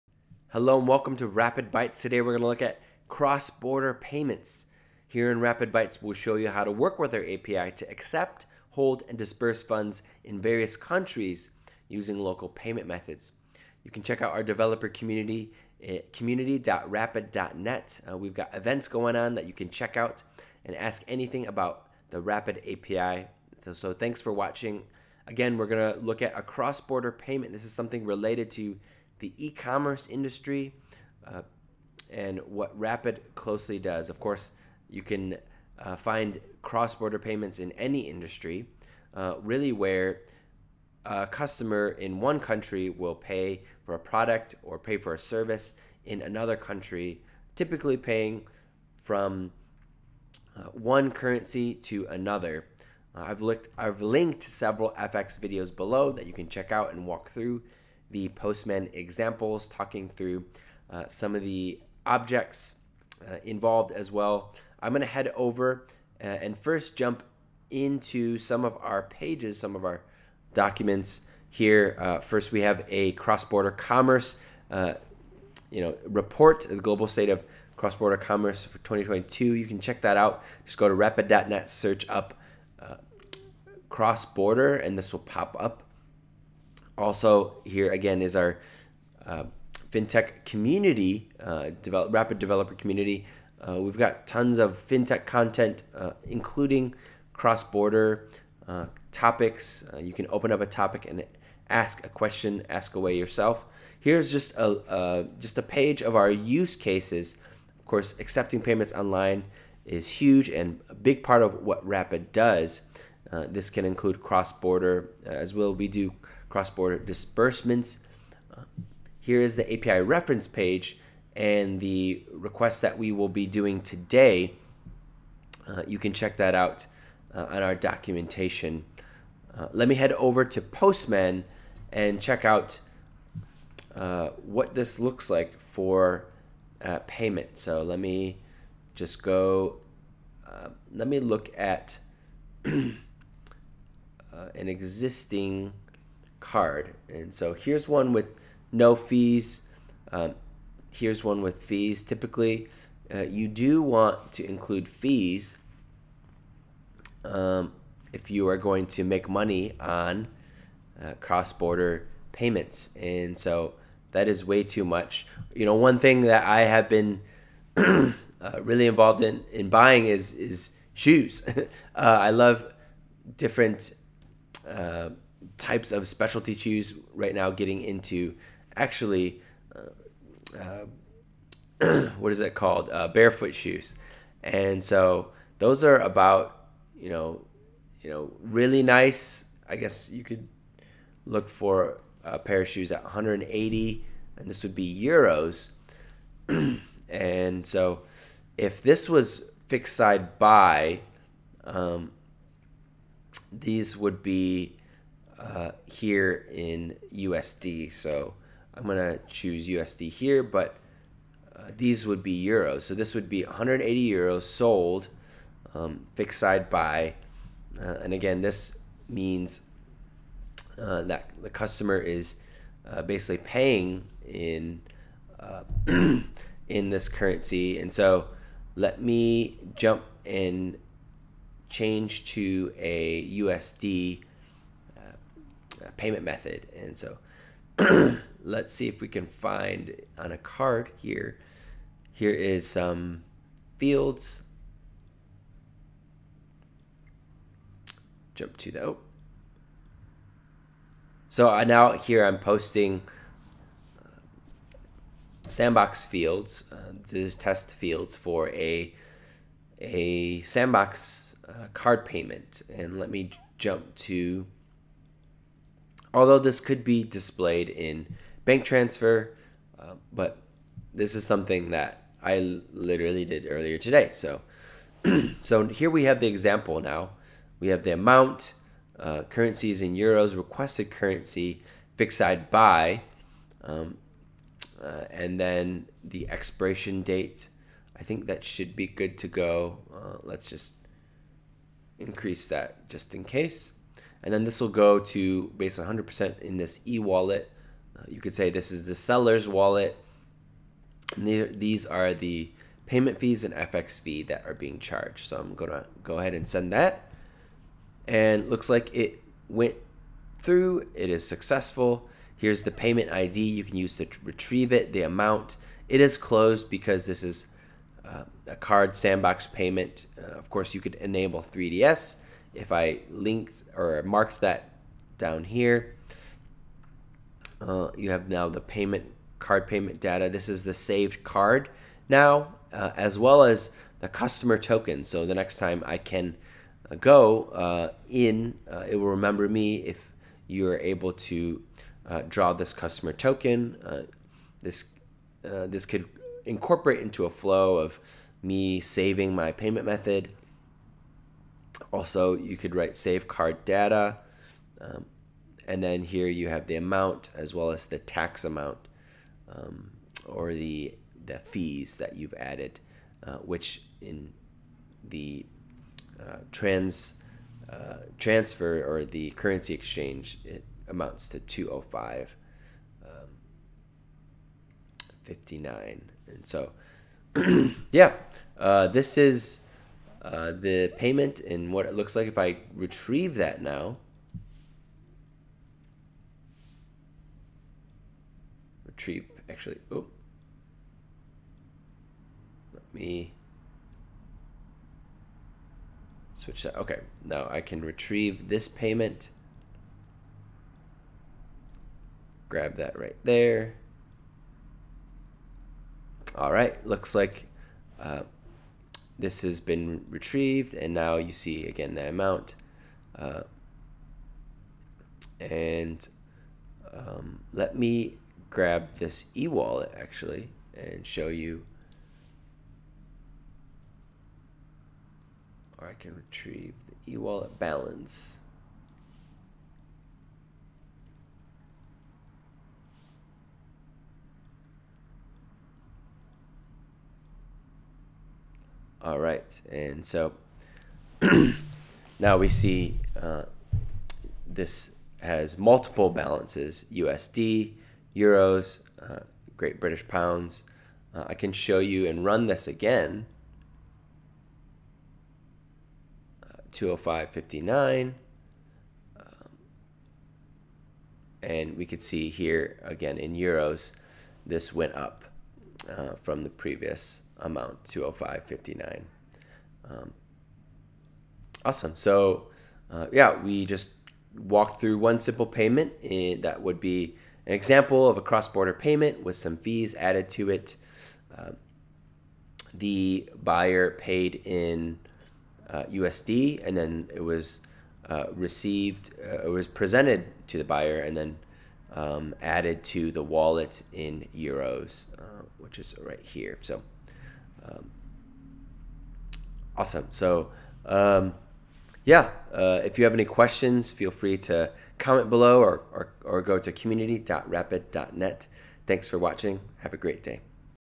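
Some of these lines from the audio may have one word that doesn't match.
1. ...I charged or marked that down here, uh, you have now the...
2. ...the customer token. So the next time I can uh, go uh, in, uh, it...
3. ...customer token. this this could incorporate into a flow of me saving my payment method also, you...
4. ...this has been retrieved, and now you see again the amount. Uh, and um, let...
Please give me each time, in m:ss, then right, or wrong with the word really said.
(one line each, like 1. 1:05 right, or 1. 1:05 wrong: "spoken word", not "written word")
1. 5:22 wrong: "linked", not "charged"
2. 5:33 right
3. 5:42 right
4. 6:49 right.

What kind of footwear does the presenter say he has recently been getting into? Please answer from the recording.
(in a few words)
barefoot shoes.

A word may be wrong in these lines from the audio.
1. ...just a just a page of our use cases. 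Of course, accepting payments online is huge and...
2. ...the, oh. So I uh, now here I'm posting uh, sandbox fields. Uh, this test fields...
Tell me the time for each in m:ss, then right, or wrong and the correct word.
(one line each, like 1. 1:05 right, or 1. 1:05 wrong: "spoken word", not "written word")
1. 1:44 right
2. 4:08 right.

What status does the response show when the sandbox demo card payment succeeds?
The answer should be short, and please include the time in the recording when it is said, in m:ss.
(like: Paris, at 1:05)
closed, at 5:16.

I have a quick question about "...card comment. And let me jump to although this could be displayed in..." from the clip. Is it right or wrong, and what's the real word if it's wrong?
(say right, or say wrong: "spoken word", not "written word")
wrong: "payment", not "comment".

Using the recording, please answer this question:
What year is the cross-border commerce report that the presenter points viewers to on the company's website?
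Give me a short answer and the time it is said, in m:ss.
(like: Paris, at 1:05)
2022, at 1:18.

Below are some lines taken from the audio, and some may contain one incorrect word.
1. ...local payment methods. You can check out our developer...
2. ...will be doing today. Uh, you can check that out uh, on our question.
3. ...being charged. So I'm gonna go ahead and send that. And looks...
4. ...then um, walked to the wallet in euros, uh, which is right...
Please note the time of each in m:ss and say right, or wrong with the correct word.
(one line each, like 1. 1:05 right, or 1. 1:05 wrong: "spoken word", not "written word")
1. 0:12 right
2. 2:03 wrong: "documentation", not "question"
3. 5:04 right
4. 8:11 wrong: "added", not "walked".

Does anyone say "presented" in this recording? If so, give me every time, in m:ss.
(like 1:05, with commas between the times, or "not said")
8:09.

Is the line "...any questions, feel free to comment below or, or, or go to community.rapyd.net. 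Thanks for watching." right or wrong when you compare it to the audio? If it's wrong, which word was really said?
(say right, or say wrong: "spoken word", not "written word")
right.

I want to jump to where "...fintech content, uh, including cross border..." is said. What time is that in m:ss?
1:34.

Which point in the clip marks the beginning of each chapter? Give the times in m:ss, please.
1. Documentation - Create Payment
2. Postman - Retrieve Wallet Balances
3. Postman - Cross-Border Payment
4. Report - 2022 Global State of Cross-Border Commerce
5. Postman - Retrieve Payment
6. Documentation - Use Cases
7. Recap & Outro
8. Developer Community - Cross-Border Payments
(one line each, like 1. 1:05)
1. 1:59
2. 7:16
3. 2:11
4. 1:13
5. 6:33
6. 1:44
7. 8:20
8. 1:27.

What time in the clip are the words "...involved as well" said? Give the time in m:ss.
1:03.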